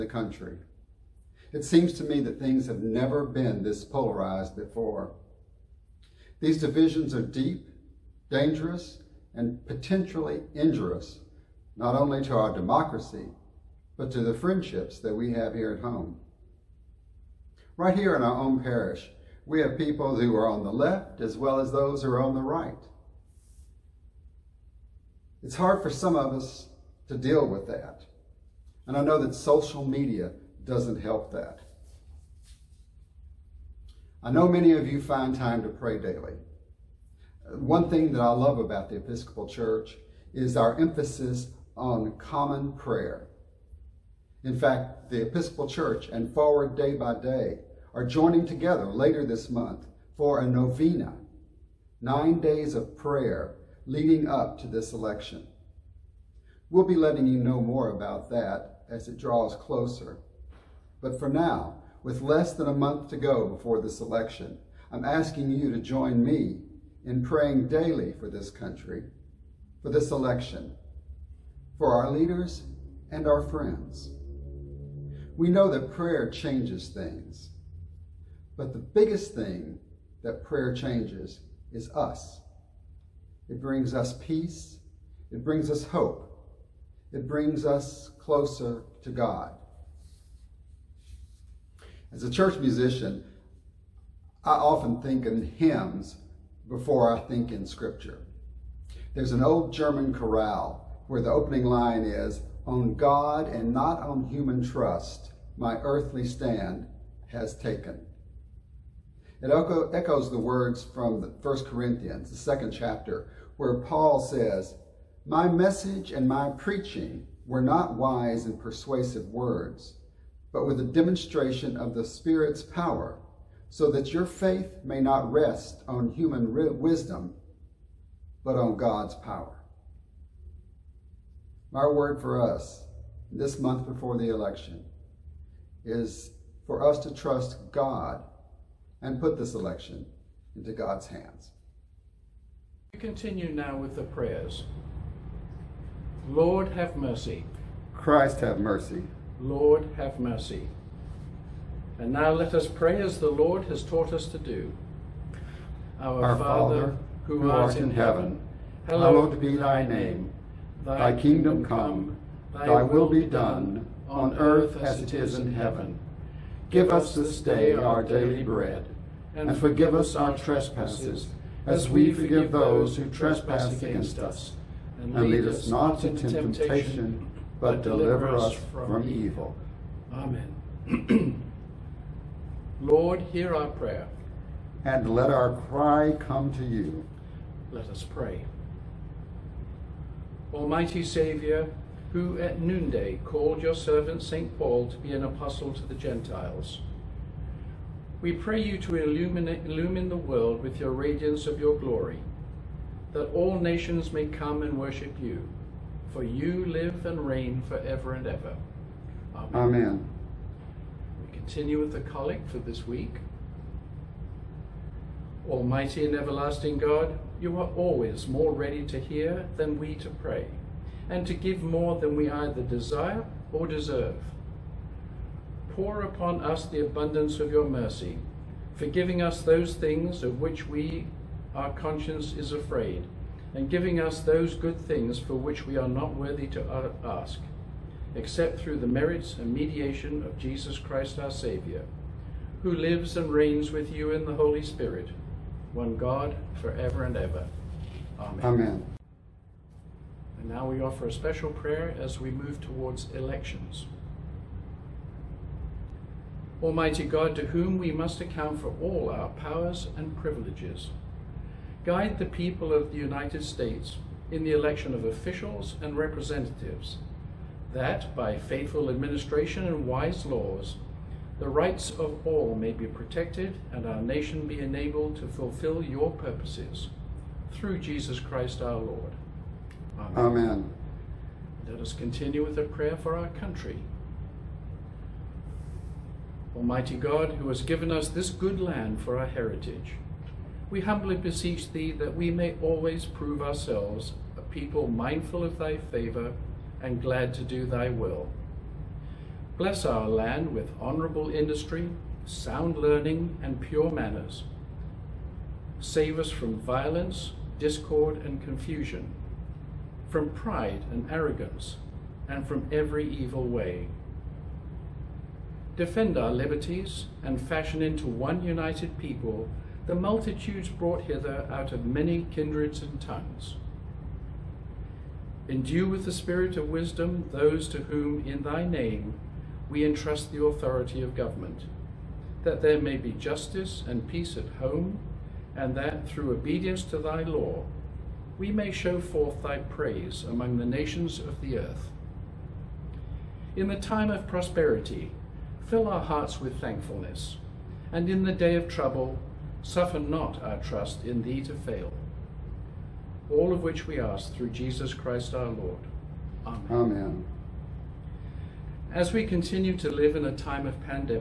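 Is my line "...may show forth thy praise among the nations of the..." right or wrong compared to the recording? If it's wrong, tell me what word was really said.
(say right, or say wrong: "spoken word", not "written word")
right.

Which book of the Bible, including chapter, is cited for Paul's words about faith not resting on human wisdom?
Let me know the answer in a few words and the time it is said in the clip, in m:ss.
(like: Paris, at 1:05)
First Corinthians, chapter 2, at 1:51.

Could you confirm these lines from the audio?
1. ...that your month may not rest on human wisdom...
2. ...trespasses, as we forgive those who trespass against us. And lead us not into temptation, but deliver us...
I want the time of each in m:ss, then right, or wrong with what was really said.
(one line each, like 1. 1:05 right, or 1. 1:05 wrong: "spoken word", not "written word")
1. 2:03 wrong: "faith", not "month"
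2. 2:50 right.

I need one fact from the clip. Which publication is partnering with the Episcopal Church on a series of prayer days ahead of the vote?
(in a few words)
Forward Day by Day.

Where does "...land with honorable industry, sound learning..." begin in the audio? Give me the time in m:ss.
5:00.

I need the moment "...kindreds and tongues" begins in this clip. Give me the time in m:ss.
5:22.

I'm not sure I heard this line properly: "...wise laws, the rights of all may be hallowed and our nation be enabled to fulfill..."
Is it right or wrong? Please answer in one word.
wrong.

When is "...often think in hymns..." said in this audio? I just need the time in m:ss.
1:34.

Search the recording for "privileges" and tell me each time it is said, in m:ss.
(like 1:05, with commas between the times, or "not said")
4:20.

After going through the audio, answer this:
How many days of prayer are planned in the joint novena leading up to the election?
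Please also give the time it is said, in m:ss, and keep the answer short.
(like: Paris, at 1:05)
9, at 0:52.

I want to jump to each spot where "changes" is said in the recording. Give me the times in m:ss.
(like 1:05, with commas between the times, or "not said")
1:16, 1:20.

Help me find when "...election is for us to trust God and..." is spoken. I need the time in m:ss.
2:14.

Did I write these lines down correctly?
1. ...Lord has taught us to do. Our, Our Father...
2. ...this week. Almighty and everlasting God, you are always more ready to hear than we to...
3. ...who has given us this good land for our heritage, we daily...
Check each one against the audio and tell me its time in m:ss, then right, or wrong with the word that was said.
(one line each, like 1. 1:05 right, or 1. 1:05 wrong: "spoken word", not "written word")
1. 2:33 right
2. 3:32 right
3. 4:47 wrong: "humbly", not "daily".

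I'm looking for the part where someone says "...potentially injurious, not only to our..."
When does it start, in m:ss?
0:09.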